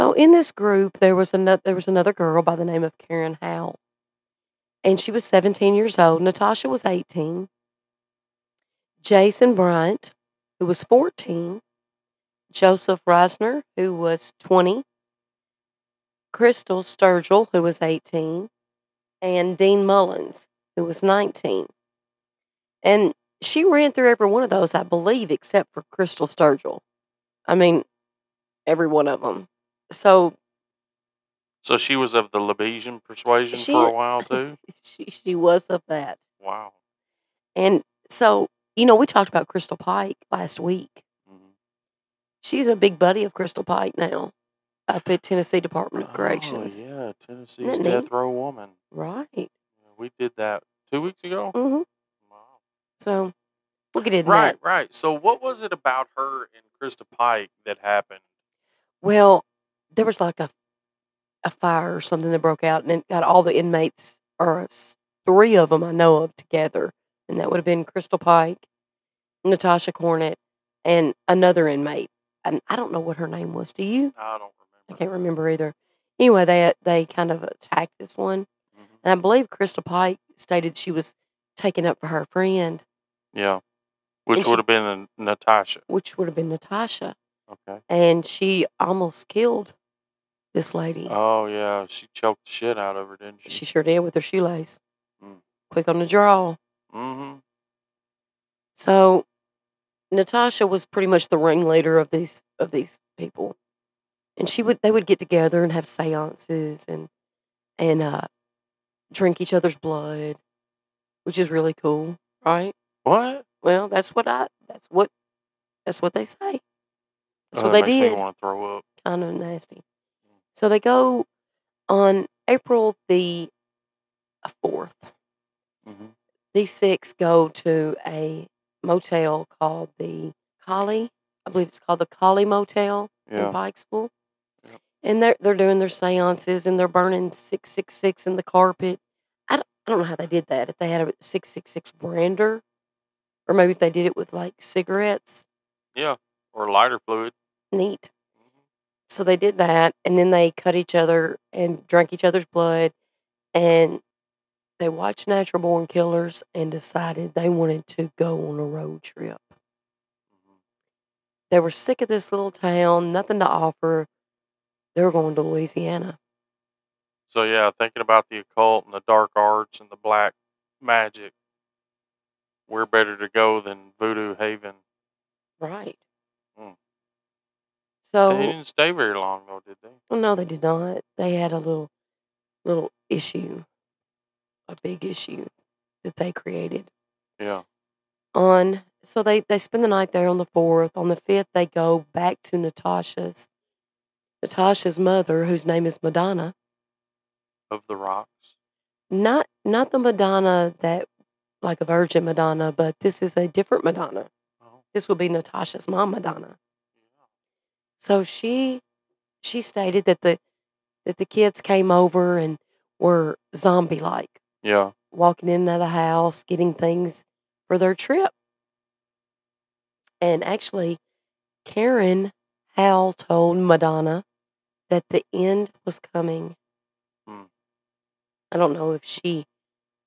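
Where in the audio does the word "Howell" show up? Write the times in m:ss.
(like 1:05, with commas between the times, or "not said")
0:03, 3:42.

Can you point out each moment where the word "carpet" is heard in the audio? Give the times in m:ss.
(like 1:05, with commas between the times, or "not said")
2:18.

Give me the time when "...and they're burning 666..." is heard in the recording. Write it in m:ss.
2:16.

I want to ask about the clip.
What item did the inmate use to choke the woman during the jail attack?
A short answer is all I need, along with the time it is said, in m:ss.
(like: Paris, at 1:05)
Her shoelace, at 1:33.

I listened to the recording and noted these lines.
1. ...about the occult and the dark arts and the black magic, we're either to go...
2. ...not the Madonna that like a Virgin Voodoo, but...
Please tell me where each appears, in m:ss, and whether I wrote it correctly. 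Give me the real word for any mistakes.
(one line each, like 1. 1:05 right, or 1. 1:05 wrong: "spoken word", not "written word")
1. 2:47 wrong: "better", not "either"
2. 3:19 wrong: "Madonna", not "Voodoo".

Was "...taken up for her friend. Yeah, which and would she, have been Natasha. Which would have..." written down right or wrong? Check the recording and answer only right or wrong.
right.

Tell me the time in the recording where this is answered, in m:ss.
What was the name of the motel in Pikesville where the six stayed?
2:12.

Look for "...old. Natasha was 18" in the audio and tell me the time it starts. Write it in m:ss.
0:05.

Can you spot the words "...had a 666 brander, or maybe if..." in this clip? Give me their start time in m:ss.
2:20.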